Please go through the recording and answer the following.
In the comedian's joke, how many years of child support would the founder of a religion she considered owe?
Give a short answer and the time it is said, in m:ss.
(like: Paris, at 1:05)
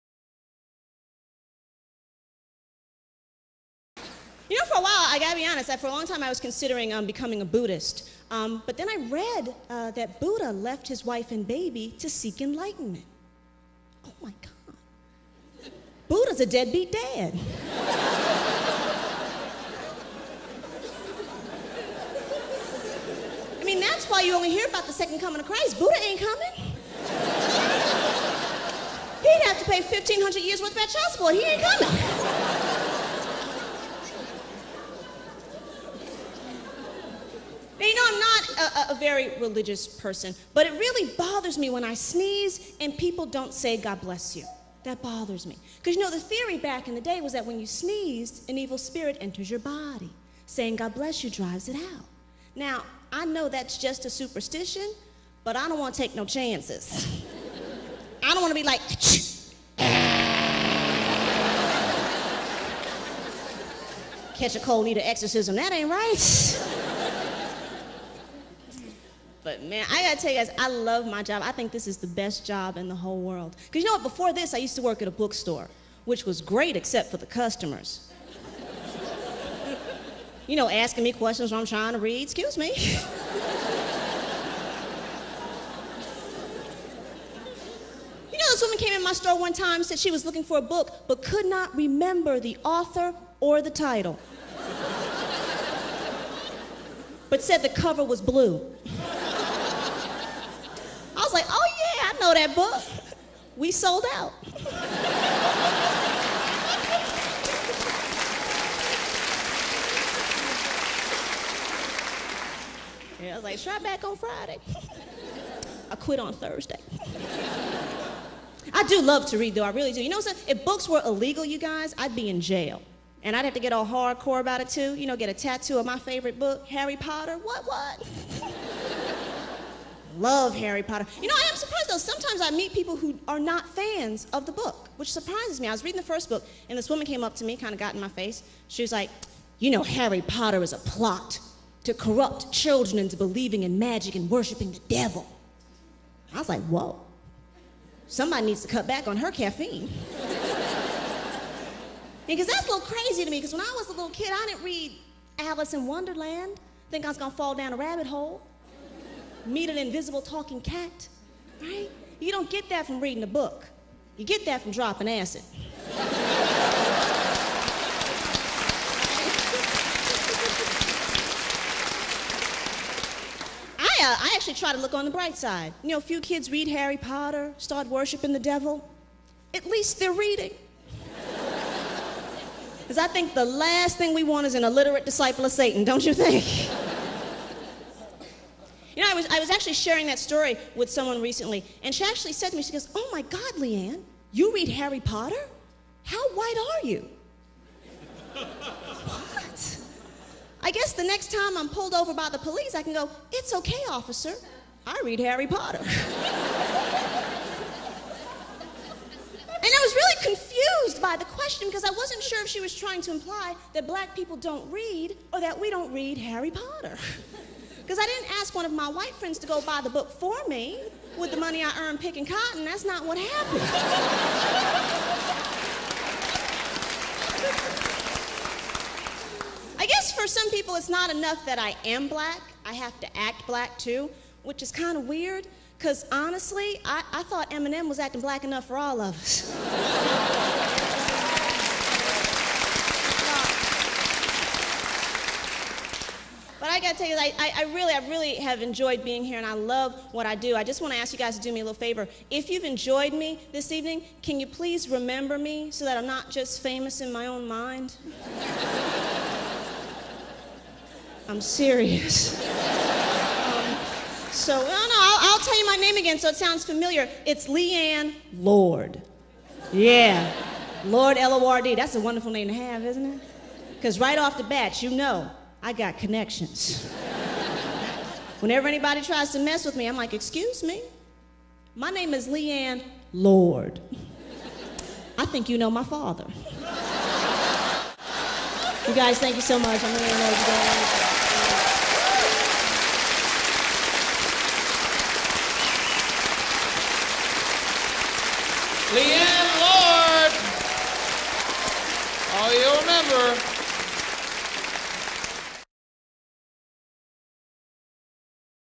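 1,500, at 0:29.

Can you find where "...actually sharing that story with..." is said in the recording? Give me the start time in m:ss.
3:09.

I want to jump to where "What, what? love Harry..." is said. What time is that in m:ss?
2:07.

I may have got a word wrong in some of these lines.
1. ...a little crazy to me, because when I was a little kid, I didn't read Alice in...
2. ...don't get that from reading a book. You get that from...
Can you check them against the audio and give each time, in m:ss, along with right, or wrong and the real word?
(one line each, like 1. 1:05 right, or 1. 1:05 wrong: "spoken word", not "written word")
1. 2:32 right
2. 2:42 right.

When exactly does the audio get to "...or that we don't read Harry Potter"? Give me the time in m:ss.
3:35.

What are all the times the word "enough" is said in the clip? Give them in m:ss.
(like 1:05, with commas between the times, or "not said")
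3:51, 3:58.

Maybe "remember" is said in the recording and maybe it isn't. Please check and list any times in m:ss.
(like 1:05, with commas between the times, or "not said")
1:31, 4:14.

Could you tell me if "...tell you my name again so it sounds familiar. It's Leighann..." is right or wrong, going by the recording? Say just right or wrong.
right.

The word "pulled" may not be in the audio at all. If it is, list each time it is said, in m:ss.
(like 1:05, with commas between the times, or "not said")
3:21.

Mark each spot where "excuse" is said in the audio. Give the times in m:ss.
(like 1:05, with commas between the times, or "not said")
1:22, 4:40.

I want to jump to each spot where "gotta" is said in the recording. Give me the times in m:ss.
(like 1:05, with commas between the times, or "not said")
0:05, 1:10.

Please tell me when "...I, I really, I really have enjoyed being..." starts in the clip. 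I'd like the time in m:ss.
4:07.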